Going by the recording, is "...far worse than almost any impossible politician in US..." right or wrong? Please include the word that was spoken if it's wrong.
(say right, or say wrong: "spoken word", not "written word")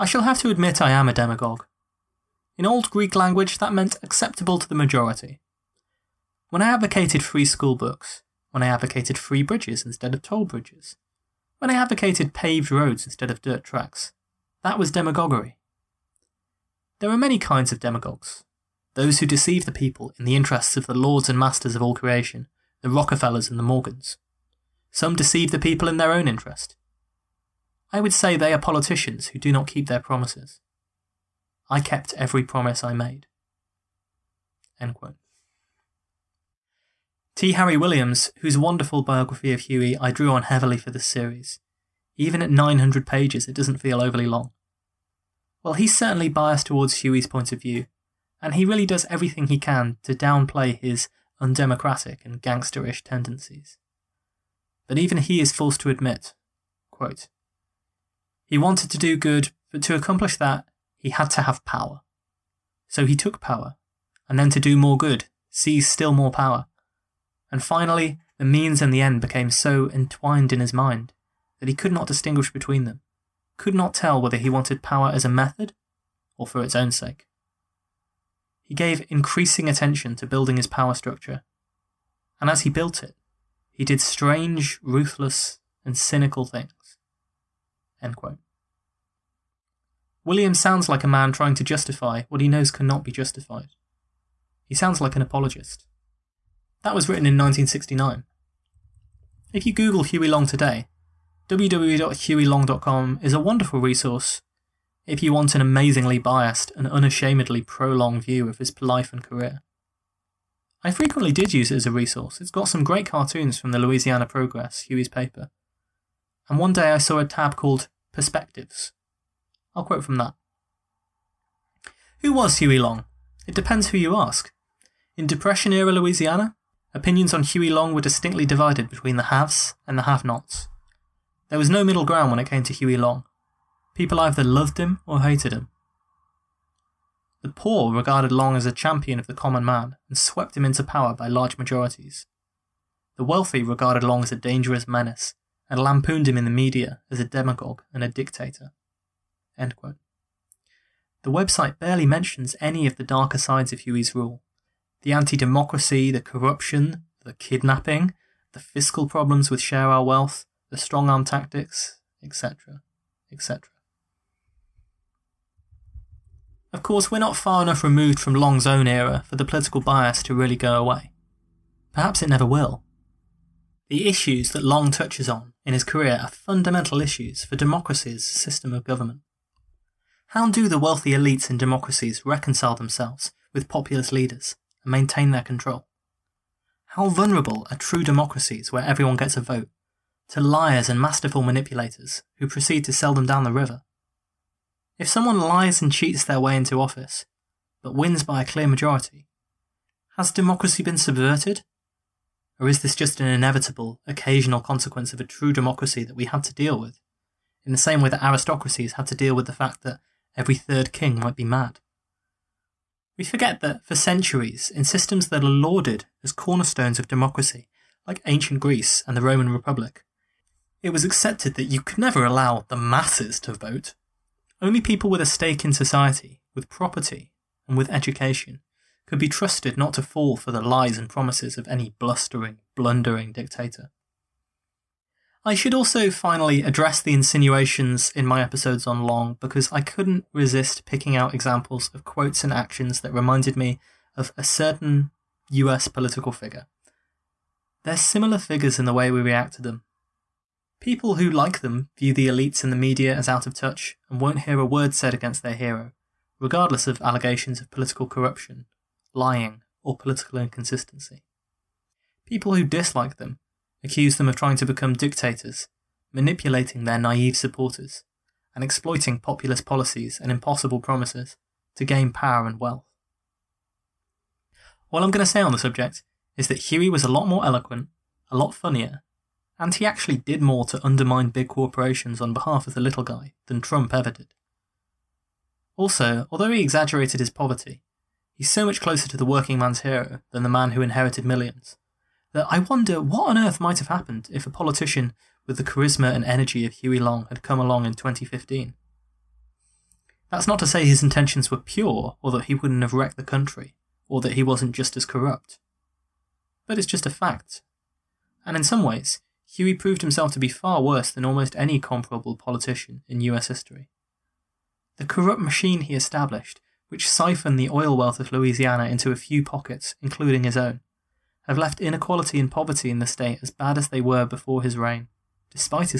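wrong: "comparable", not "impossible".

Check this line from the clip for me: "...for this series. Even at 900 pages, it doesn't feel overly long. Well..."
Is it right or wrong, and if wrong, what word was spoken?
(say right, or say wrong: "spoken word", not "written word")
right.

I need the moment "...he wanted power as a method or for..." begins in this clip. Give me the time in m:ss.
1:14.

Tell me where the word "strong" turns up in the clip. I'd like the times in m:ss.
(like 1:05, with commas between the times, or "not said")
2:40.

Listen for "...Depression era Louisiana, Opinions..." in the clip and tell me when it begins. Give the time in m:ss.
2:05.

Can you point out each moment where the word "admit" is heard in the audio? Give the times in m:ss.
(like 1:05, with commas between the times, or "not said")
0:00, 0:55.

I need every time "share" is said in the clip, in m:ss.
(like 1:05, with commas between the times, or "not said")
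2:39.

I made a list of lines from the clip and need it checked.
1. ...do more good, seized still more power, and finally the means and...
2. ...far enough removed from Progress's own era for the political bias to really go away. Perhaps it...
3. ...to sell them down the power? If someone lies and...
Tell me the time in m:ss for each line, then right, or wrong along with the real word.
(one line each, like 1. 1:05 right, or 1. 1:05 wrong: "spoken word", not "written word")
1. 1:04 right
2. 2:47 wrong: "Long", not "Progress"
3. 3:12 wrong: "river", not "power".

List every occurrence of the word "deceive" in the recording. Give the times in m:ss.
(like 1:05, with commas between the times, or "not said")
0:19, 0:25.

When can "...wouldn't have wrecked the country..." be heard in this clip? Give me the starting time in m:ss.
5:02.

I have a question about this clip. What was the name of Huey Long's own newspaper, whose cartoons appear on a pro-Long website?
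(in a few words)
Louisiana Progress.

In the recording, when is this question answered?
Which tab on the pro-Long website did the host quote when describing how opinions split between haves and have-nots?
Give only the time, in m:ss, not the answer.
1:58.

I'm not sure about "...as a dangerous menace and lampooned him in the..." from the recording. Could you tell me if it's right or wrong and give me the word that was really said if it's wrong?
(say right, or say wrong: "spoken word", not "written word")
right.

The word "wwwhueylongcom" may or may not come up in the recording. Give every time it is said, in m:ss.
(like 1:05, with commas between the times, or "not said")
1:41.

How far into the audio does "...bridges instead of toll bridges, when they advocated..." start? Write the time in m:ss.
0:09.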